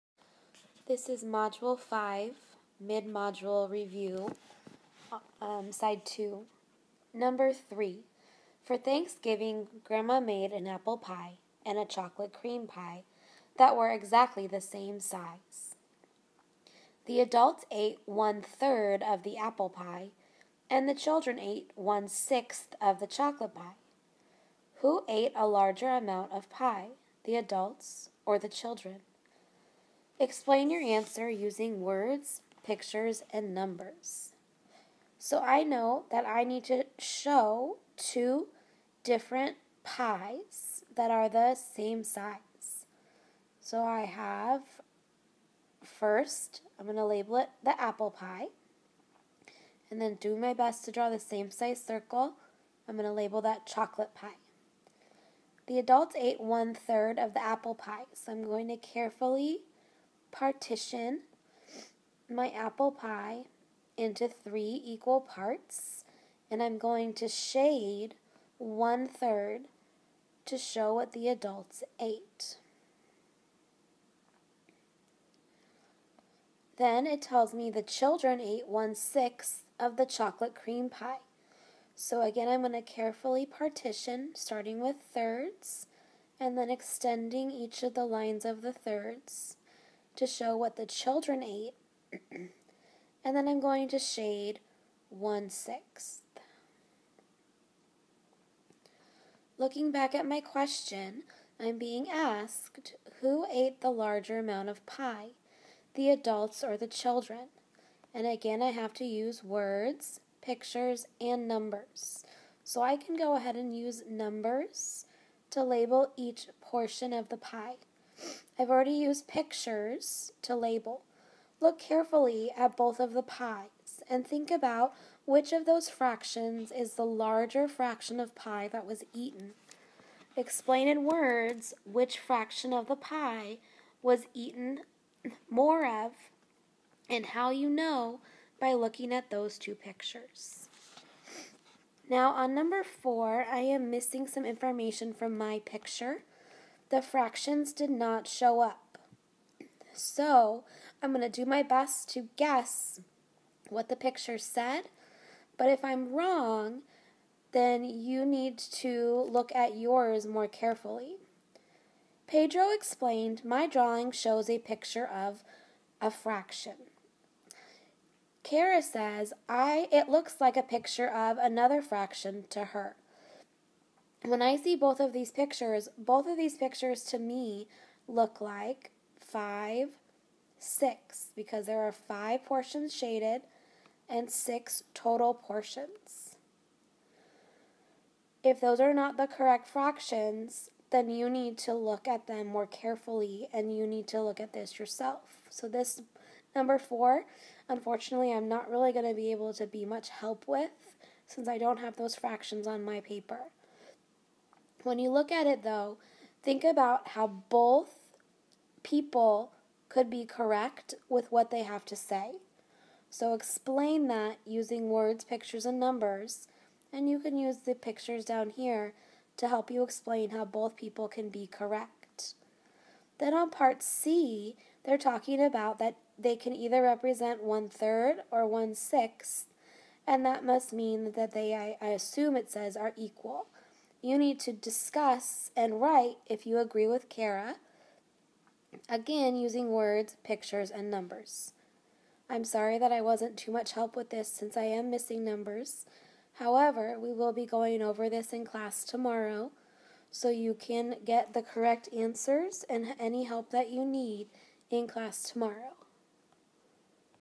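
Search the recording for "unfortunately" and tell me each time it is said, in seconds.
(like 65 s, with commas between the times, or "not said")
197 s.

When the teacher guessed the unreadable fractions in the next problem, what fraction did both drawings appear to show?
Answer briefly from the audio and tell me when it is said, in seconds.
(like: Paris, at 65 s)
5/6, at 179 s.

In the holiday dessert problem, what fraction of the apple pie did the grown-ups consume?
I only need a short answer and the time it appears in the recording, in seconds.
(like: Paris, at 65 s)
1/3, at 18 s.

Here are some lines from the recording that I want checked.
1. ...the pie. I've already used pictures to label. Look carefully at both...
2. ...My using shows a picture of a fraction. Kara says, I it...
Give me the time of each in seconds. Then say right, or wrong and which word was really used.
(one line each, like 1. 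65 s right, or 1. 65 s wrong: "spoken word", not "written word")
1. 117 s right
2. 163 s wrong: "drawing", not "using".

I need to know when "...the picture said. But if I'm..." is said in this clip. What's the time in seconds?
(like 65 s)
153 s.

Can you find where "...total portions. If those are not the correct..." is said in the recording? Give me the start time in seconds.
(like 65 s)
184 s.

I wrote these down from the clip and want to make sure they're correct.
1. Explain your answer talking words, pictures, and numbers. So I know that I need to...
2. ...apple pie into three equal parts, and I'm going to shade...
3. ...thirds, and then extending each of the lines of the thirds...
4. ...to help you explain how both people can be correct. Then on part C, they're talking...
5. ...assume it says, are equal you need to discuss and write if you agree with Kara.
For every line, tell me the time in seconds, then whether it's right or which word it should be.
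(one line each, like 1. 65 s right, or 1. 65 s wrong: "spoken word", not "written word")
1. 30 s wrong: "using", not "talking"
2. 62 s right
3. 85 s right
4. 219 s right
5. 231 s right.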